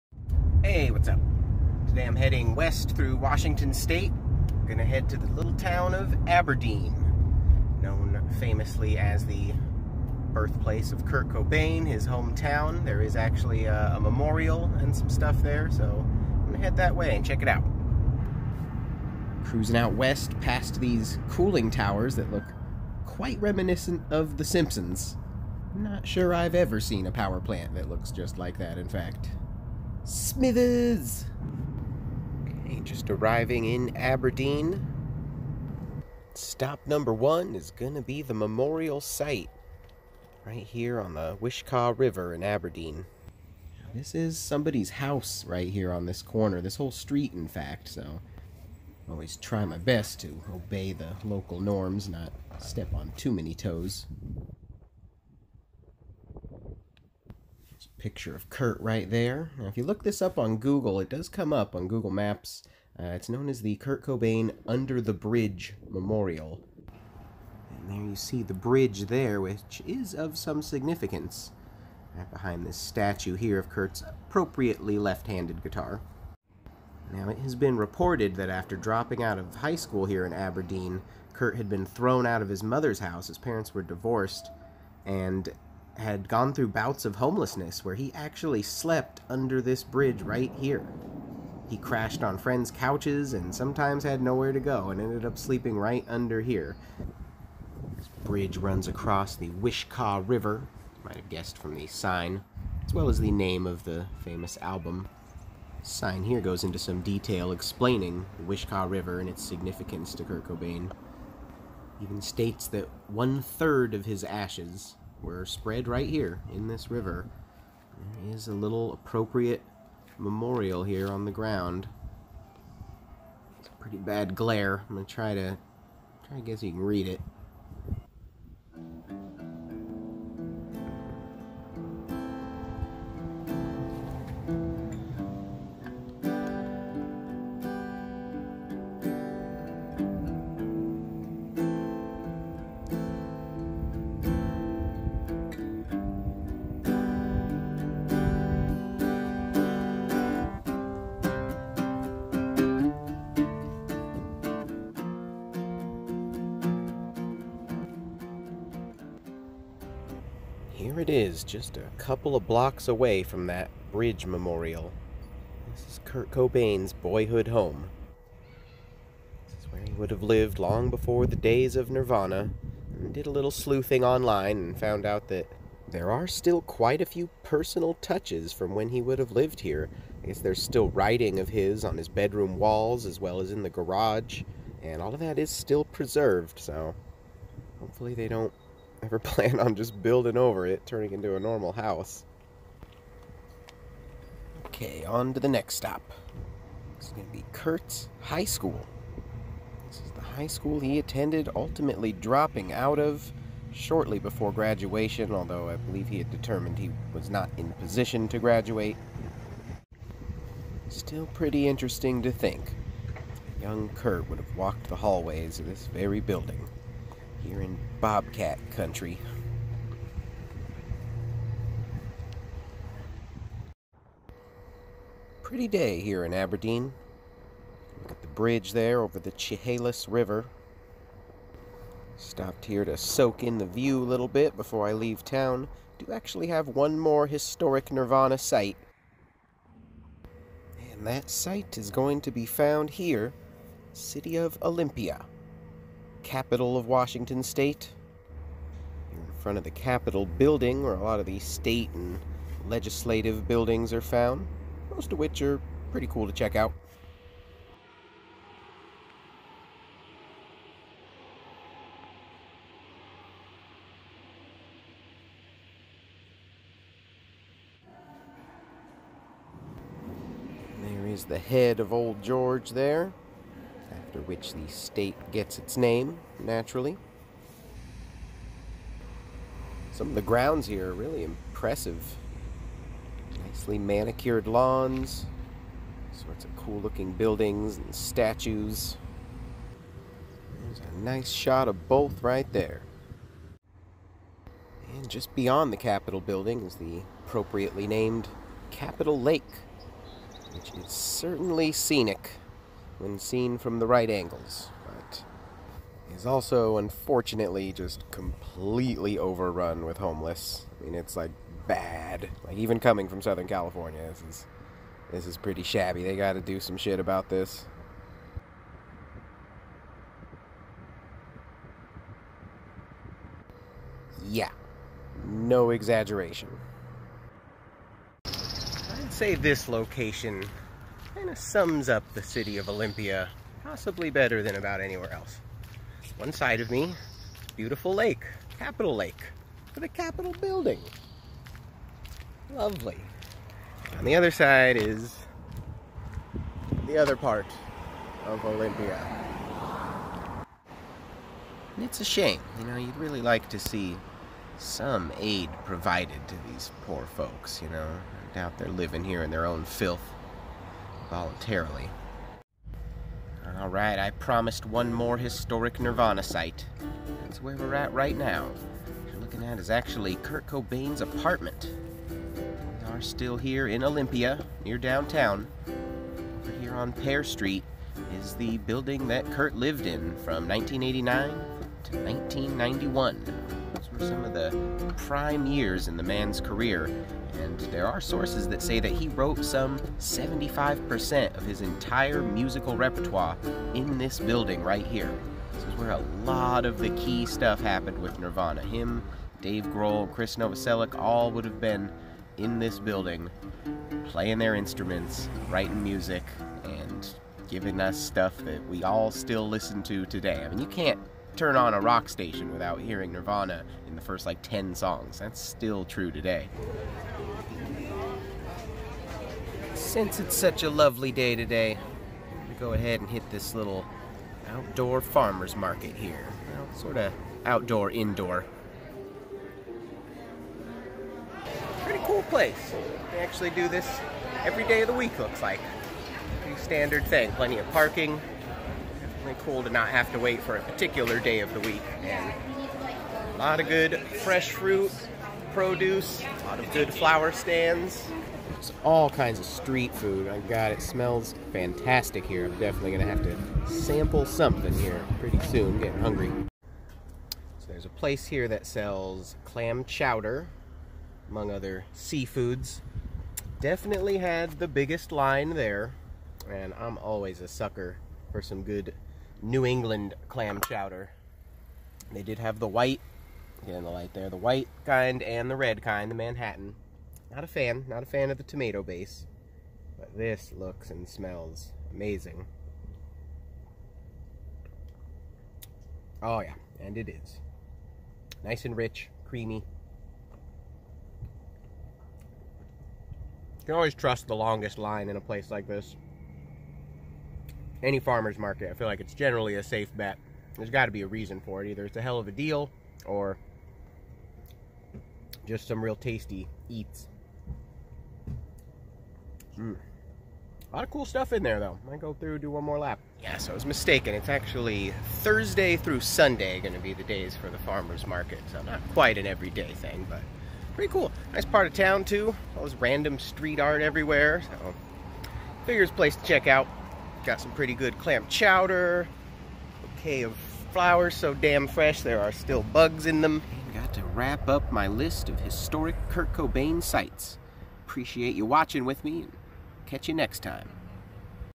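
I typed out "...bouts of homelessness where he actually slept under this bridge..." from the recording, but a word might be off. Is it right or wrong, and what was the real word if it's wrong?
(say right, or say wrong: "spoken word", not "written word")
right.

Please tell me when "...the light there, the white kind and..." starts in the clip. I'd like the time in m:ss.
7:53.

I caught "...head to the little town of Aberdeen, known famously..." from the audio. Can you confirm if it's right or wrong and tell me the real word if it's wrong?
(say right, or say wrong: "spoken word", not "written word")
right.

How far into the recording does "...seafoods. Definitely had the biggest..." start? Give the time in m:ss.
7:41.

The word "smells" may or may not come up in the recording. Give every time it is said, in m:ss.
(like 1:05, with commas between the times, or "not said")
7:30, 8:01.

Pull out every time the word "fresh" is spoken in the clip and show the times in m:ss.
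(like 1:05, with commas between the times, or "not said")
7:24, 8:51.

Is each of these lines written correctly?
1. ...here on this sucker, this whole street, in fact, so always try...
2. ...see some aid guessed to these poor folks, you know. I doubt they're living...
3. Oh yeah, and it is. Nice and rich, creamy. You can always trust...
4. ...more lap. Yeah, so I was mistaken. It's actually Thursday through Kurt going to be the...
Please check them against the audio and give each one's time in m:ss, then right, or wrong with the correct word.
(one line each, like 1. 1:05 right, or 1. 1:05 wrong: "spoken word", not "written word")
1. 0:45 wrong: "corner", not "sucker"
2. 5:53 wrong: "provided", not "guessed"
3. 8:06 right
4. 8:32 wrong: "Sunday", not "Kurt".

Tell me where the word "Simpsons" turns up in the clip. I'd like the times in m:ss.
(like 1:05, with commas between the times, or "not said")
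0:24.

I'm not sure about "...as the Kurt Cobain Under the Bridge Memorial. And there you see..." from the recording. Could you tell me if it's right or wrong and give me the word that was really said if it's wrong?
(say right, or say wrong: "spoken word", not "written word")
right.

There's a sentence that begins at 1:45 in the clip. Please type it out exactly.
Sign here goes into some detail explaining the Wishkah River and its significance to Kurt Cobain.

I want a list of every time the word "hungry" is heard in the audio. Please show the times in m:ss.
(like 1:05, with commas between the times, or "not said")
7:35.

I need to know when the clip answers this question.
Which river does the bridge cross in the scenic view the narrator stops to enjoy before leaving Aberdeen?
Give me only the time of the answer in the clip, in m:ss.
3:49.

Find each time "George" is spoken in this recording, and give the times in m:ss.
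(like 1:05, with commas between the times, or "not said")
4:32.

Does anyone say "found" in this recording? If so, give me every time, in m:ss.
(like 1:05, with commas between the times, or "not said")
2:54, 4:02, 4:14.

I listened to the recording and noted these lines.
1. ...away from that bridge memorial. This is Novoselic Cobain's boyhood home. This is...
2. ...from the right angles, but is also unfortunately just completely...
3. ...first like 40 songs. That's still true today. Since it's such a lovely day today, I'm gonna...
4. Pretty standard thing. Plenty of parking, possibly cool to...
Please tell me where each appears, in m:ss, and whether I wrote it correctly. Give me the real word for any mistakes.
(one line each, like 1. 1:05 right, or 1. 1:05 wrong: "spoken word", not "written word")
1. 2:42 wrong: "Kurt", not "Novoselic"
2. 5:03 right
3. 6:54 wrong: "10", not "40"
4. 7:16 wrong: "definitely", not "possibly".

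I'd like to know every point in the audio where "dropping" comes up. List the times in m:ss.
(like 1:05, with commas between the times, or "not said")
1:18, 3:22.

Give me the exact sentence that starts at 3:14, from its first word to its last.
Okay, on to the next stop.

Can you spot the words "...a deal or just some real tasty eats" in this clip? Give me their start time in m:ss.
8:22.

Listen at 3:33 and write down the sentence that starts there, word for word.
Young Kurt would have walked the hallways of this very building.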